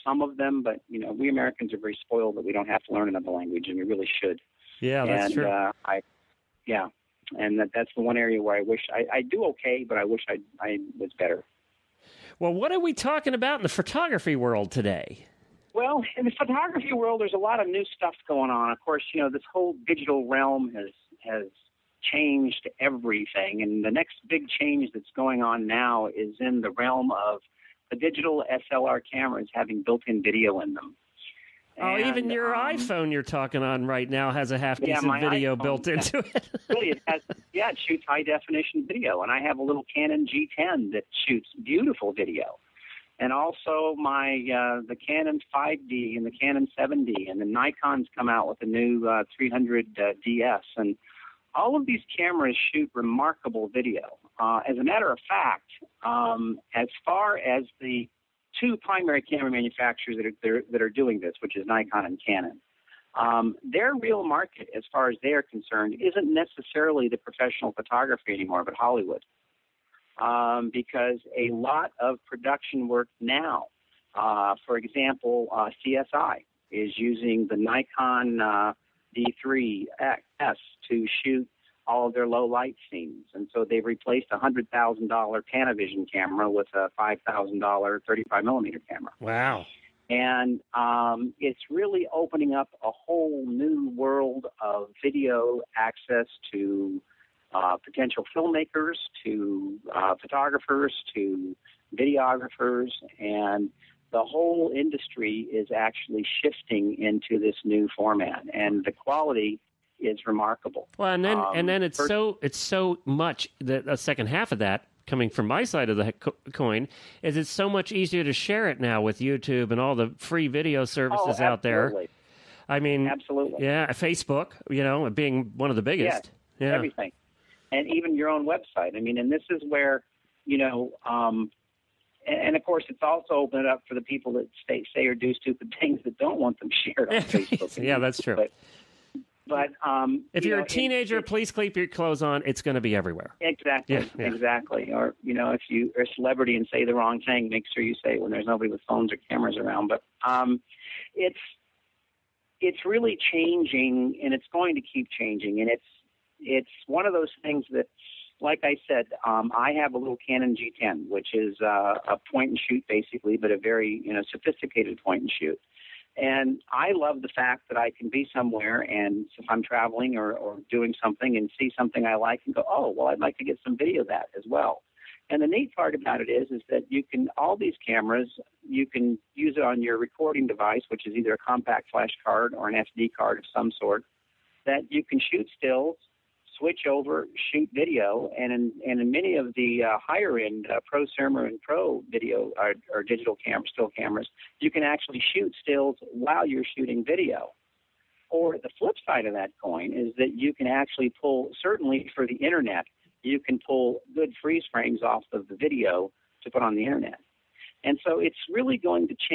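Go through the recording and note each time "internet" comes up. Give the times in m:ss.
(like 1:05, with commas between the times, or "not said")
3:22, 3:26.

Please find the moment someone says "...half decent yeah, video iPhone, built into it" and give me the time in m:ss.
0:34.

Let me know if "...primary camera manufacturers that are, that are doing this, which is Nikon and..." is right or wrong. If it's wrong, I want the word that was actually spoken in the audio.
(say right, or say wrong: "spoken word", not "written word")
right.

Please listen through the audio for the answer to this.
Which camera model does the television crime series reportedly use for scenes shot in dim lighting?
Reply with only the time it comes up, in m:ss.
1:17.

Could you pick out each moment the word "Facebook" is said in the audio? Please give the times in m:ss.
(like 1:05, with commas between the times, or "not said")
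2:03, 2:17.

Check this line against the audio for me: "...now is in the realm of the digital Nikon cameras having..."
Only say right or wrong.
wrong.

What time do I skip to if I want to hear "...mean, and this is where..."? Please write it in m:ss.
2:09.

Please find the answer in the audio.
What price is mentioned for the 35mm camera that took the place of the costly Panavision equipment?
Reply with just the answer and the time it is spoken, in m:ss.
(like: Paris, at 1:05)
$5,000, at 1:26.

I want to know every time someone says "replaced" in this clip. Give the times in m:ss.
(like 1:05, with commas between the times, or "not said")
1:23.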